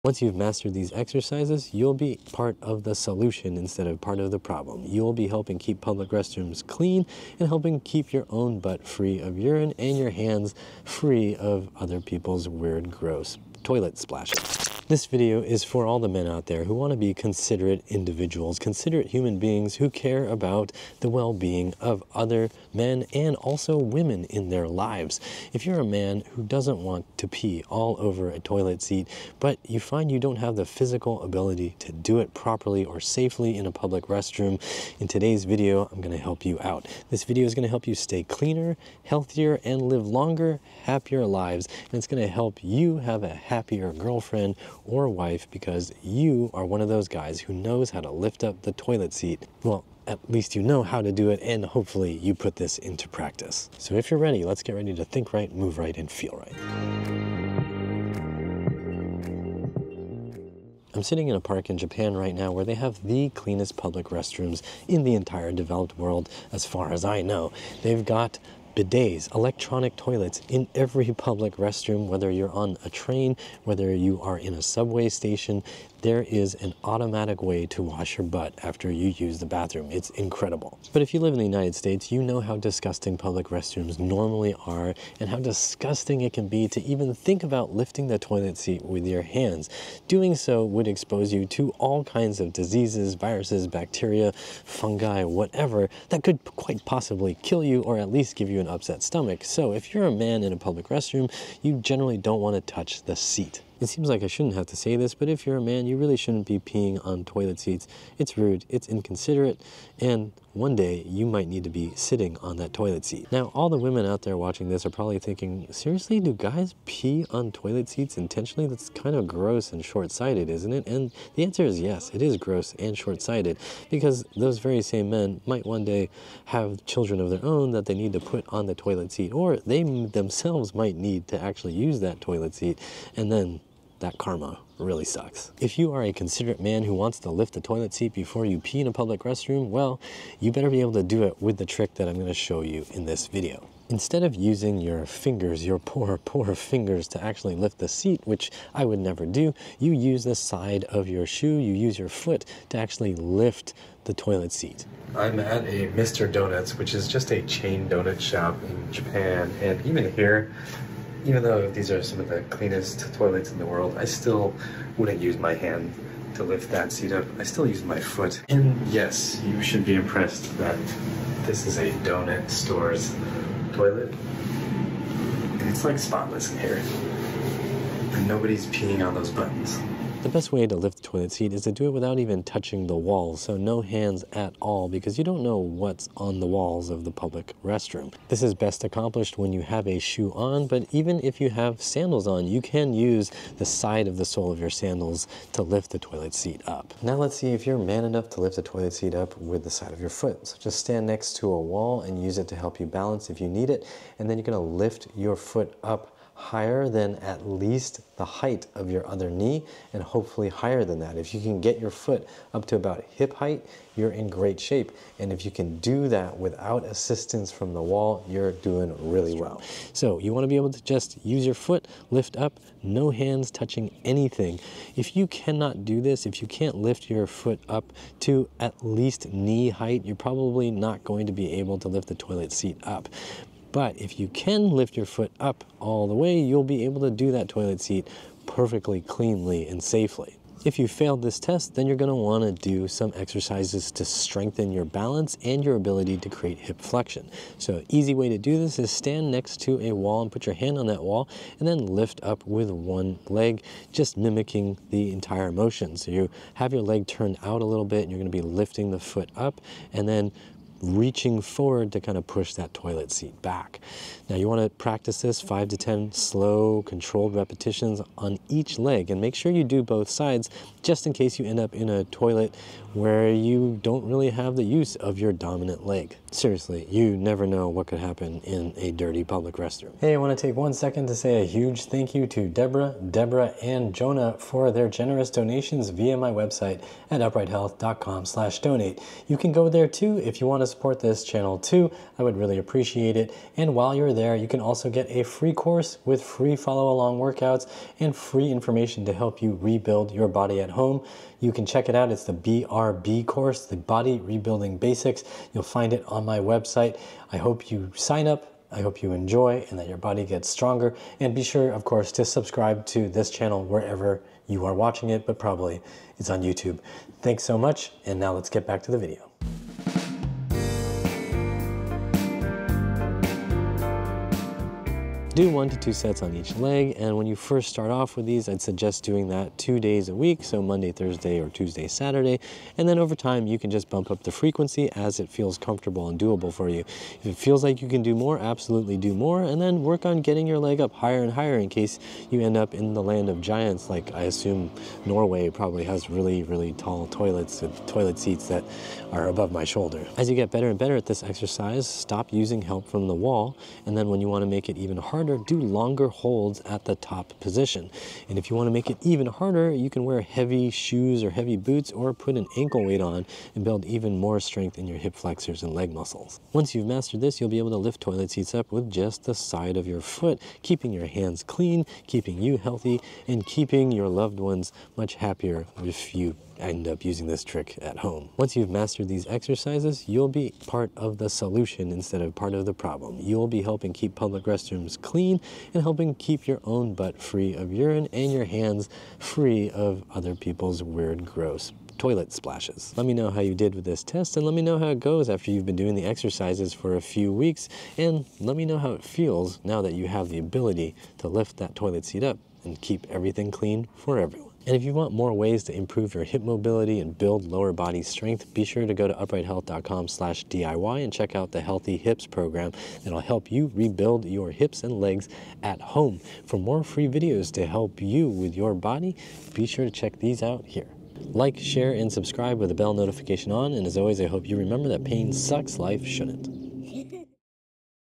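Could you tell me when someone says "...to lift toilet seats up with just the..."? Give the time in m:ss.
6:07.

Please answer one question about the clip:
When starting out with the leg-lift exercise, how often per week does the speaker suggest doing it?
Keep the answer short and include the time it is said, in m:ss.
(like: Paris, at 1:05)
2 days a week, at 5:29.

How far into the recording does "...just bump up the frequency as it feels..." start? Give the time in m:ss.
5:33.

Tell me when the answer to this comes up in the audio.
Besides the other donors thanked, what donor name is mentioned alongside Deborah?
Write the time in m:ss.
4:43.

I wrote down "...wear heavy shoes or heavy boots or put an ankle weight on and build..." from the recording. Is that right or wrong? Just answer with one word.
right.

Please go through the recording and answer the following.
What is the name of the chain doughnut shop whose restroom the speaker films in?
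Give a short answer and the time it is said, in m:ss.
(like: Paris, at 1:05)
Mr. Donuts, at 2:35.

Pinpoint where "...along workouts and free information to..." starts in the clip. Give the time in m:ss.
4:56.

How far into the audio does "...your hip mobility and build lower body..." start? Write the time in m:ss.
6:46.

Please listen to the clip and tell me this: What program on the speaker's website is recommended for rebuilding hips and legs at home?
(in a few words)
Healthy Hips.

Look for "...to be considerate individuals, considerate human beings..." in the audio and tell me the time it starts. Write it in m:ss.
0:16.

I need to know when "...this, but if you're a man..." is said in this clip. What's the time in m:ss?
1:44.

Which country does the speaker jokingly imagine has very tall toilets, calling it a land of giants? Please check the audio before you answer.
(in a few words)
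Norway.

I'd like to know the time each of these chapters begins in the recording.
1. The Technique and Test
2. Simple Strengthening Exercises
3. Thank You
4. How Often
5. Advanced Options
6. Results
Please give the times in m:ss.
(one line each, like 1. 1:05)
1. 2:23
2. 4:00
3. 4:40
4. 5:19
5. 5:50
6. 6:18.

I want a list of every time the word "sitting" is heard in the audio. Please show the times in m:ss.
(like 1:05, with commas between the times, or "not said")
1:01, 1:51.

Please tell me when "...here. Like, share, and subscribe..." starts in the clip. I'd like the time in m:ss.
7:00.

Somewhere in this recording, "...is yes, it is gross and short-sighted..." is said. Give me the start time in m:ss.
2:01.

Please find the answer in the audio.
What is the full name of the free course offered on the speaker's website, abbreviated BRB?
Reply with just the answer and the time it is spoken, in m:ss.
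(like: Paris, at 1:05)
Body Rebuilding Basics, at 5:03.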